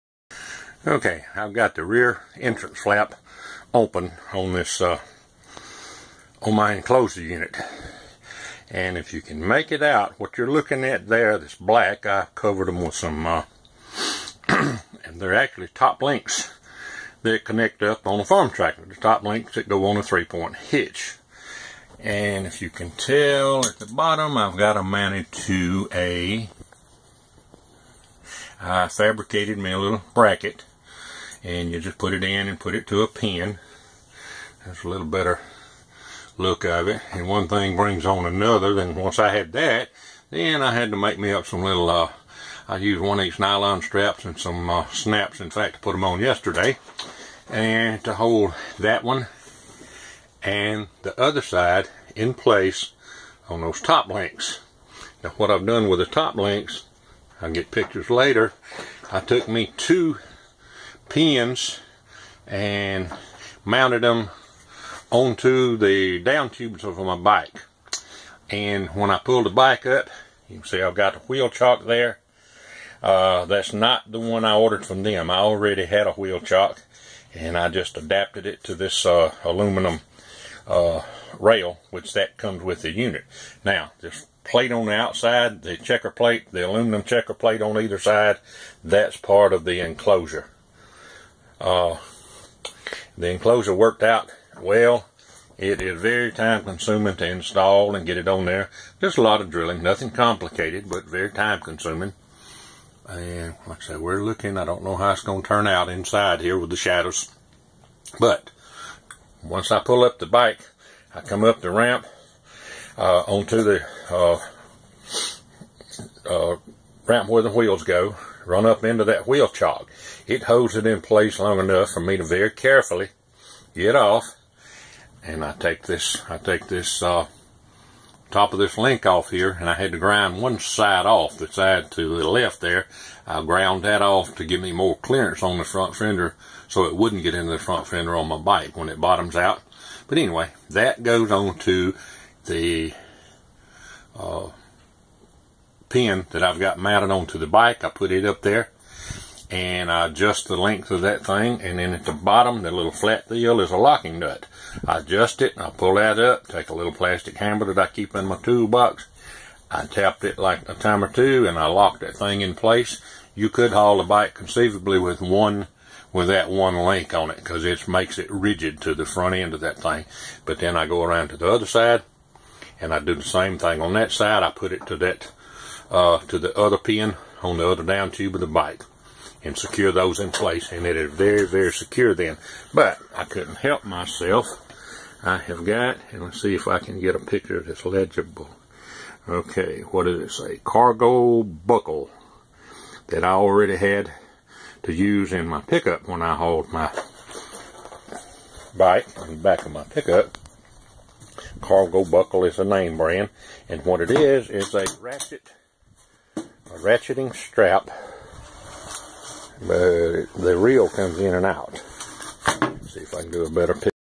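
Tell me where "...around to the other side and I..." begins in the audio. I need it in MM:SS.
02:51.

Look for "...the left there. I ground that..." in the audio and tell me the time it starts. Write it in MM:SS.
02:12.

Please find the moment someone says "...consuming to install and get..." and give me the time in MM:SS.
01:36.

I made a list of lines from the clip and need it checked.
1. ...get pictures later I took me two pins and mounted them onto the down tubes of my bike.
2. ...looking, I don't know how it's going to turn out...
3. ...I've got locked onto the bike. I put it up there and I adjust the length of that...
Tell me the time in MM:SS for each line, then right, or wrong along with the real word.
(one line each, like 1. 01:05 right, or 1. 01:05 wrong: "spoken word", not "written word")
1. 00:57 right
2. 01:44 right
3. 02:26 wrong: "mounted", not "locked".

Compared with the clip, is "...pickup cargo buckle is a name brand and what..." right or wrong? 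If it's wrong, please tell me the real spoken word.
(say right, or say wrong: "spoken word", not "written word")
right.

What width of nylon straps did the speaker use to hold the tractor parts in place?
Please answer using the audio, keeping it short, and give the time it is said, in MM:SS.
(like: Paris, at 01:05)
1 inch, at 00:43.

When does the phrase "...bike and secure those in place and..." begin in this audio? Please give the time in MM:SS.
02:58.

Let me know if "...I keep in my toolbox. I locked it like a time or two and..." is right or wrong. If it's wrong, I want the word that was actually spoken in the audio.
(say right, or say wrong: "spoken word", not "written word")
wrong: "tapped", not "locked".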